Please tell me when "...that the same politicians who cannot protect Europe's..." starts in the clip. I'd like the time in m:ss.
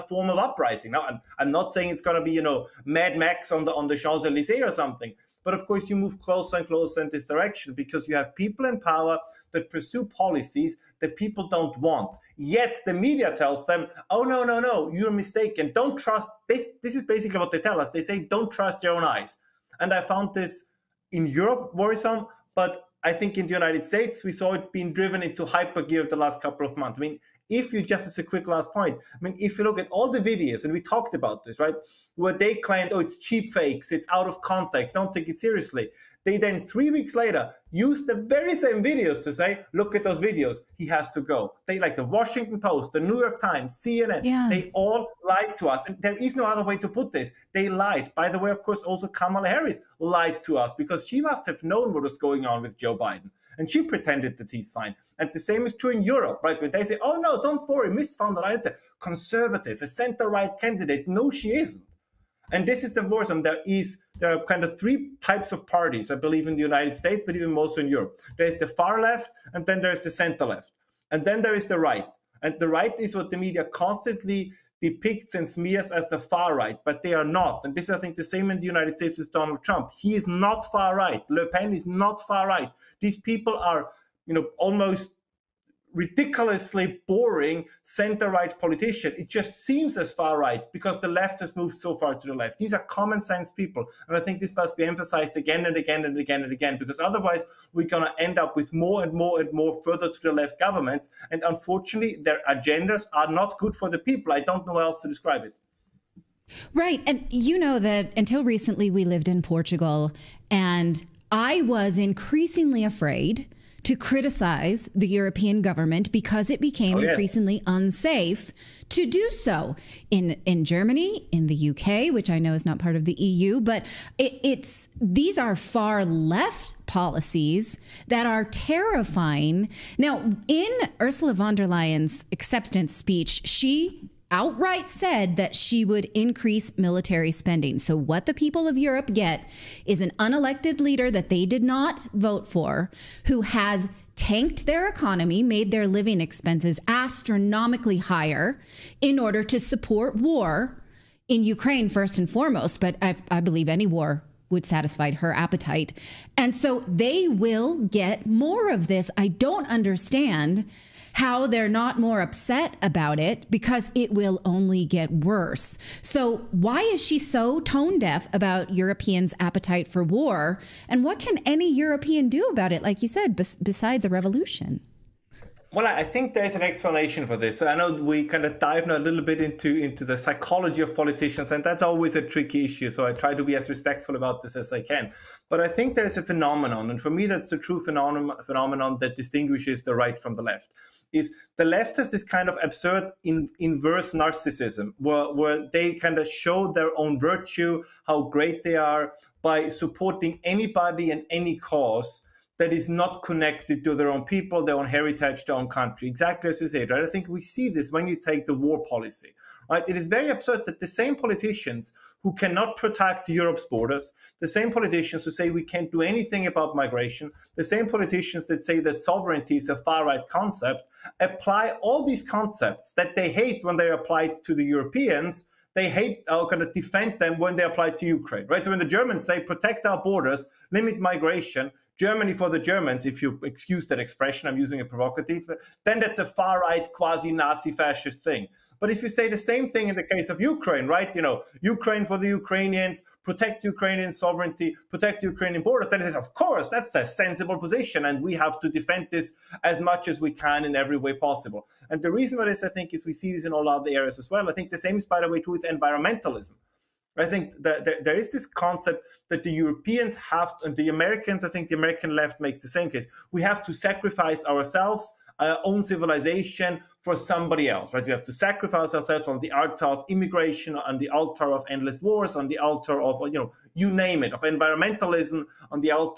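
3:30.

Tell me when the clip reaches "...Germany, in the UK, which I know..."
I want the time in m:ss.
2:00.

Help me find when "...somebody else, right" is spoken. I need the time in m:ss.
4:27.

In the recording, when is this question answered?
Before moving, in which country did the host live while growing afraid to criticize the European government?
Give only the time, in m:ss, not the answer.
1:49.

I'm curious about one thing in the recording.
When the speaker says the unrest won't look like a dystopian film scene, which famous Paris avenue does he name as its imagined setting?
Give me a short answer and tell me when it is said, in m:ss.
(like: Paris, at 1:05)
Champs Elysees, at 0:03.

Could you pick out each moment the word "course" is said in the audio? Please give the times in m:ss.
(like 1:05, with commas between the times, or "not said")
0:05, 0:48, 4:06.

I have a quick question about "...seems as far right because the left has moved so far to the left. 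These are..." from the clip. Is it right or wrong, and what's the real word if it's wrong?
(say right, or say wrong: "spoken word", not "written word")
right.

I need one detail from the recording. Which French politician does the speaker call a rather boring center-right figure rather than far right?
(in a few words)
Le Pen.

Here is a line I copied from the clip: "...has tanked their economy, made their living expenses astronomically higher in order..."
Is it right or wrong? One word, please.
right.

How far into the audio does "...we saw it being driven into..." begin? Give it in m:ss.
0:24.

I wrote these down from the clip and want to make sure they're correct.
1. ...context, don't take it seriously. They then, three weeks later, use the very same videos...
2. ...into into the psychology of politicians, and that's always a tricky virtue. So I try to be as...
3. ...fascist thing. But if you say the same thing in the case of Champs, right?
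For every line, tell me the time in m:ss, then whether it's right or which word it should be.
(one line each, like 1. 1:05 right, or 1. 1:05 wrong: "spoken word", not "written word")
1. 0:34 right
2. 2:59 wrong: "issue", not "virtue"
3. 3:57 wrong: "Ukraine", not "Champs".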